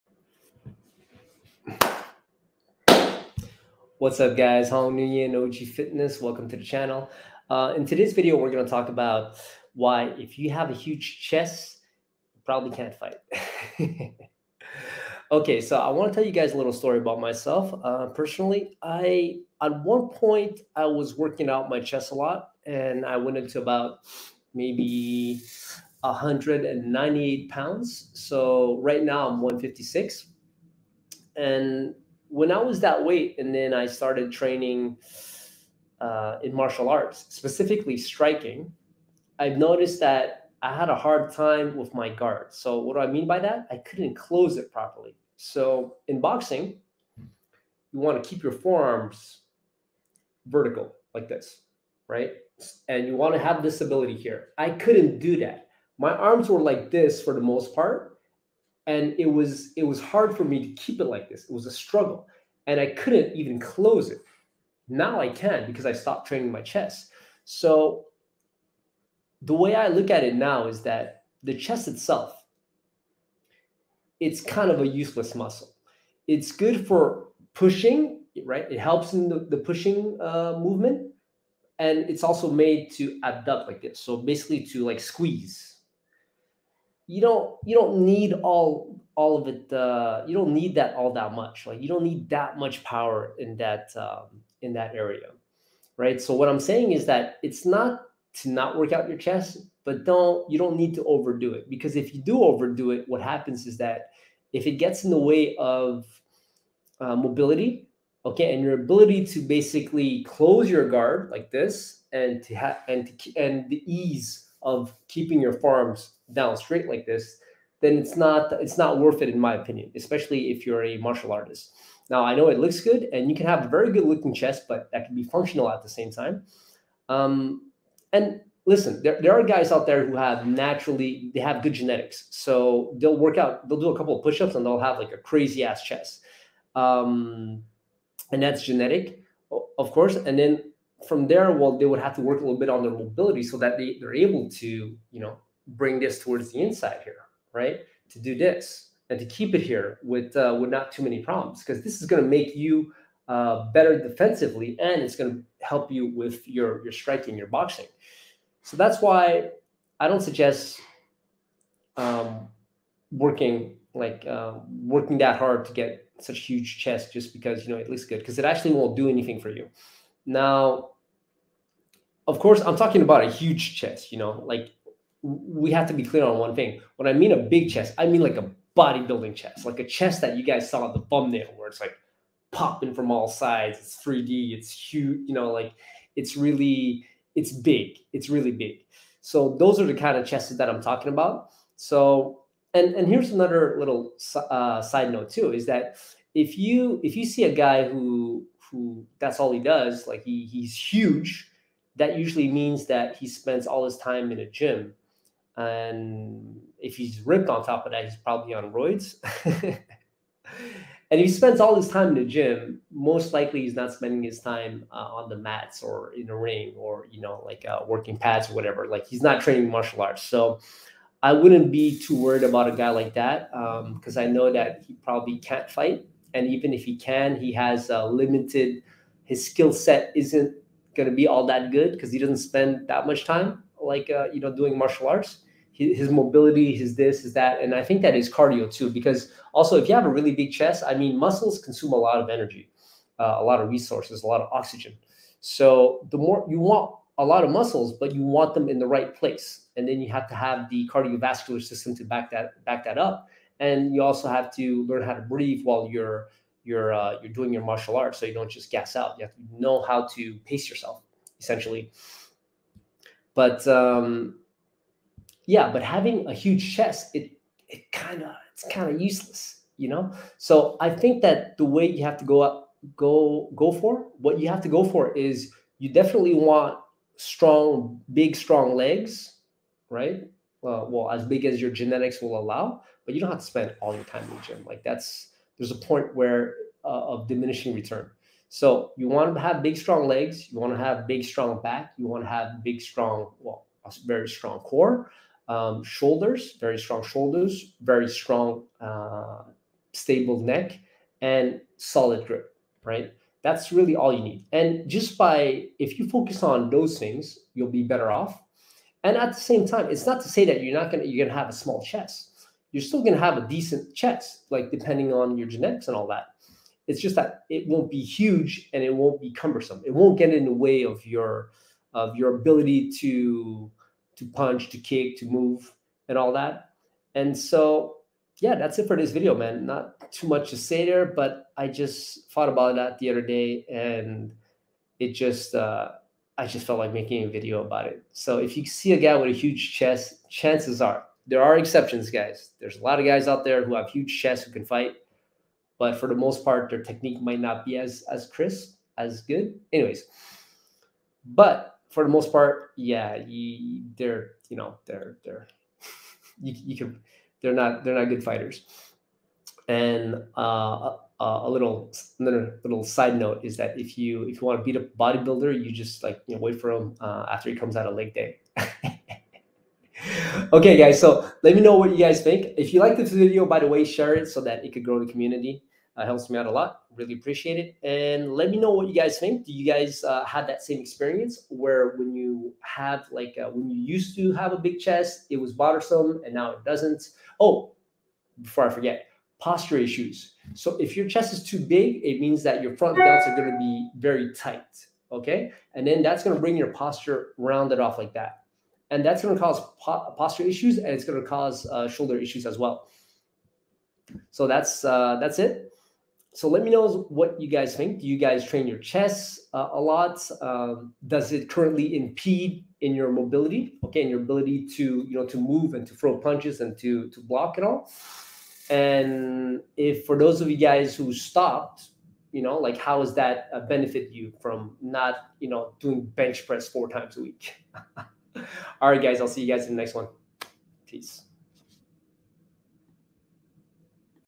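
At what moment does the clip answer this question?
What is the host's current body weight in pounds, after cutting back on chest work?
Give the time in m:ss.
0:29.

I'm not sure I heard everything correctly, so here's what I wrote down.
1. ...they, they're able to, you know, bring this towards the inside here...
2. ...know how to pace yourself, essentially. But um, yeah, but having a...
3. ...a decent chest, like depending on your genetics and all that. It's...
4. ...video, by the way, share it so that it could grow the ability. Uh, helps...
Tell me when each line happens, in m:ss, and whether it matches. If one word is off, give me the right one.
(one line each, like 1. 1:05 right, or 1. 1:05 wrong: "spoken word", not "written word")
1. 2:23 right
2. 4:19 right
3. 5:13 right
4. 6:13 wrong: "community", not "ability".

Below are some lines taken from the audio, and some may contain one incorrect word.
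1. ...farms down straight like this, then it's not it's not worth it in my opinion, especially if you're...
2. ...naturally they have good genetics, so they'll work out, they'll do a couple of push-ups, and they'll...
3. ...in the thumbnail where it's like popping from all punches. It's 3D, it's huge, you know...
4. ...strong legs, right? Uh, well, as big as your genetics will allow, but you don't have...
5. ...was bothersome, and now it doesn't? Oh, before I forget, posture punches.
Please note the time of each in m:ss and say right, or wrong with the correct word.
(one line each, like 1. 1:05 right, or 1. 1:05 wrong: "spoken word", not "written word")
1. 1:55 right
2. 2:10 right
3. 3:00 wrong: "sides", not "punches"
4. 4:38 right
5. 6:25 wrong: "issues", not "punches".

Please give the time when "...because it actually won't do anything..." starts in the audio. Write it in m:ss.
2:48.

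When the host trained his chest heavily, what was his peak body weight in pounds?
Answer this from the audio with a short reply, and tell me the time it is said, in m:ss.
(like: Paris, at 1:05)
198, at 0:25.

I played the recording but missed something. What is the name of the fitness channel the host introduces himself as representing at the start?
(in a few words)
OG Fitness.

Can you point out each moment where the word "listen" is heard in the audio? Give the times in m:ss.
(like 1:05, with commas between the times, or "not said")
2:08.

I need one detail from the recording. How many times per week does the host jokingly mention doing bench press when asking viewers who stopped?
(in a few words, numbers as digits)
4.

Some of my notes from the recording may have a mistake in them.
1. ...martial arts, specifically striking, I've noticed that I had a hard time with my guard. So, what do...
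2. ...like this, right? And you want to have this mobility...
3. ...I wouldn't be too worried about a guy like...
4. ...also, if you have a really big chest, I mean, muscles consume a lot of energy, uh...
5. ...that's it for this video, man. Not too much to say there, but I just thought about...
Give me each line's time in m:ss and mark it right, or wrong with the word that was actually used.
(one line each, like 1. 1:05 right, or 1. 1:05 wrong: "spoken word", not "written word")
1. 0:36 right
2. 0:51 wrong: "ability", not "mobility"
3. 3:41 right
4. 3:59 right
5. 5:28 right.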